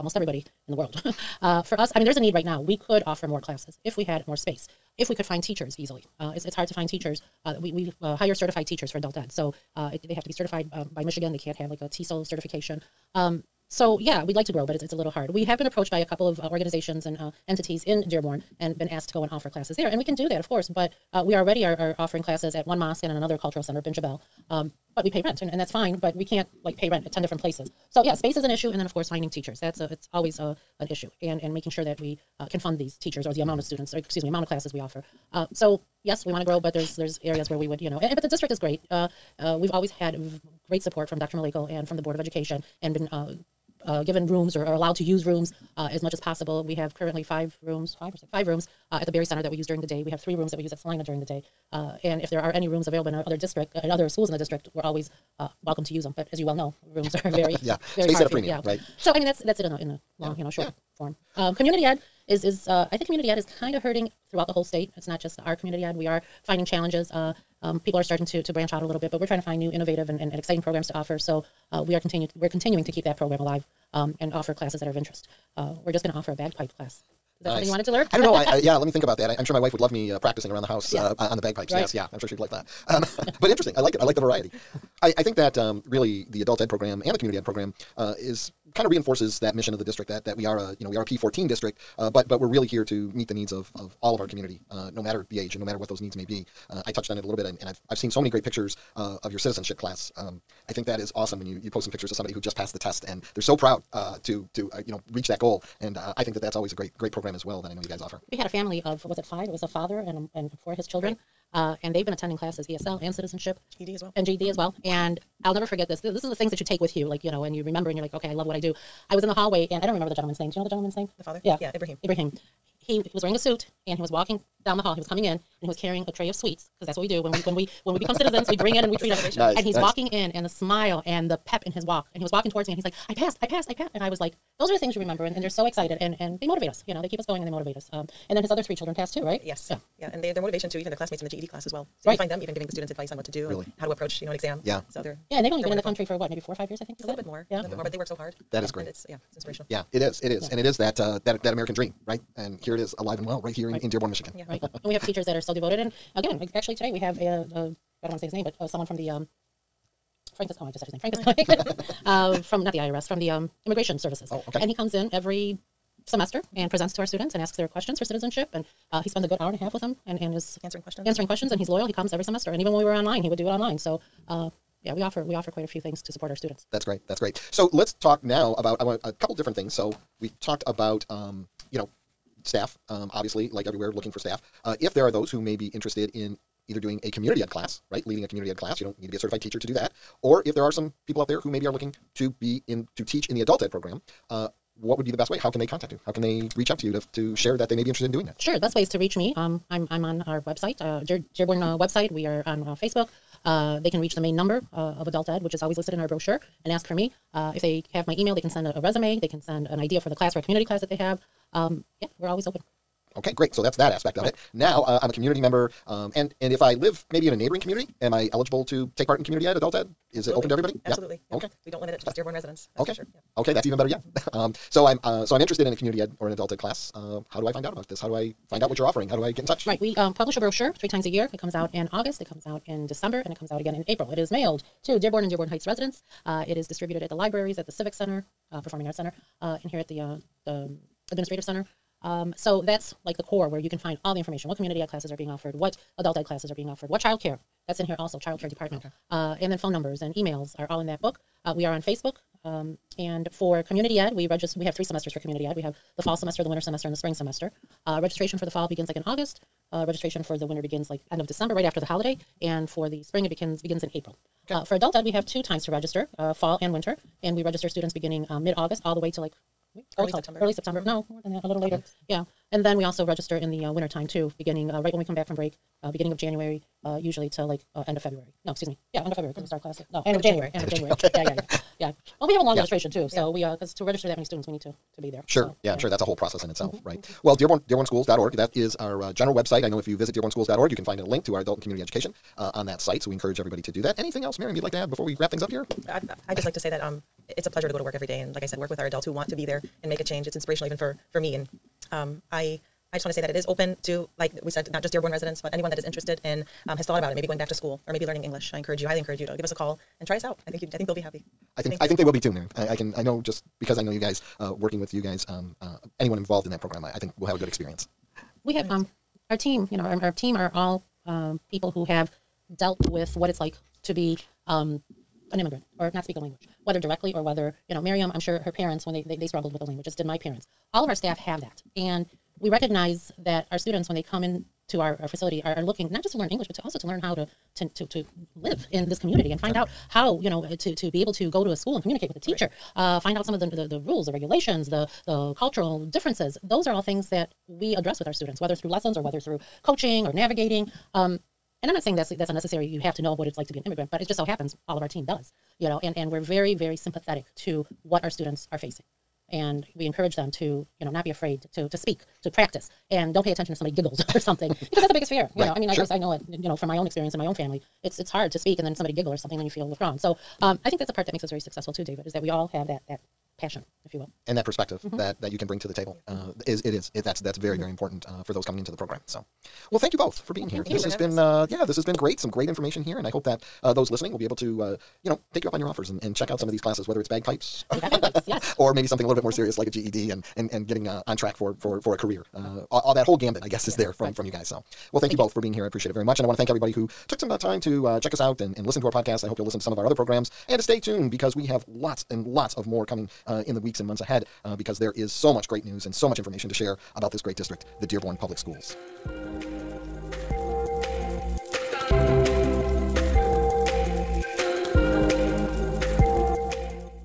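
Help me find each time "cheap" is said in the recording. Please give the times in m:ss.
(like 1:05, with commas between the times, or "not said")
not said.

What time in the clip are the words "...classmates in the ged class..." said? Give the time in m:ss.
2:20.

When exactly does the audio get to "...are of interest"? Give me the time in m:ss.
1:14.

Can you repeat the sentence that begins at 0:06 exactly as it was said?
Uh, it's, it's hard to find teachers.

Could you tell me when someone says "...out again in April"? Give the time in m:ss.
3:53.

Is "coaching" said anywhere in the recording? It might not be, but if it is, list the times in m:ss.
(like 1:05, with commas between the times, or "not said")
5:49.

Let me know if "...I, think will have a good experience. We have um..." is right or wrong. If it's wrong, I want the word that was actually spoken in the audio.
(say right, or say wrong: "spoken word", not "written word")
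right.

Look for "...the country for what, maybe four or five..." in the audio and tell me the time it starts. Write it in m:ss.
2:25.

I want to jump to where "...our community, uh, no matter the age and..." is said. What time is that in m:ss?
1:34.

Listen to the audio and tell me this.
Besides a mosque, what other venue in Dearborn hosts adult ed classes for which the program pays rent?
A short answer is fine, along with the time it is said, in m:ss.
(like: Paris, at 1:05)
Bin, at 0:23.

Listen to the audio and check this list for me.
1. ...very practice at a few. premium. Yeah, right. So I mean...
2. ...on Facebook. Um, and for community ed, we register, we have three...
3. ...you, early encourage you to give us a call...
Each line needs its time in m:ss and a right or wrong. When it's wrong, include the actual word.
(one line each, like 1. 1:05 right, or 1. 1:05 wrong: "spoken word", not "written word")
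1. 0:57 wrong: "space", not "practice"
2. 4:11 right
3. 5:08 wrong: "highly", not "early".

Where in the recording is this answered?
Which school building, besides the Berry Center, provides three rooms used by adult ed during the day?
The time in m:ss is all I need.
0:50.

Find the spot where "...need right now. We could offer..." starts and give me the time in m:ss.
0:02.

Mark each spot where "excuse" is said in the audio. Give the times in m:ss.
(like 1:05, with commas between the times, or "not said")
0:33, 4:38.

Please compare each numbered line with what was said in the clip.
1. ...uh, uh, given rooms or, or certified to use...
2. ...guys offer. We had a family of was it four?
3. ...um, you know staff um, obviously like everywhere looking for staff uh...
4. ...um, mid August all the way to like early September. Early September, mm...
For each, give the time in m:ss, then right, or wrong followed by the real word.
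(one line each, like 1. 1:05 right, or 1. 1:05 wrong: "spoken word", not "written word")
1. 0:43 wrong: "allowed", not "certified"
2. 1:47 wrong: "five", not "four"
3. 3:01 right
4. 4:28 right.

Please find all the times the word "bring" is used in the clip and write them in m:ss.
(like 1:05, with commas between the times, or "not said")
2:08, 6:15.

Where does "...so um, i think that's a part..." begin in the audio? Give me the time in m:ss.
6:09.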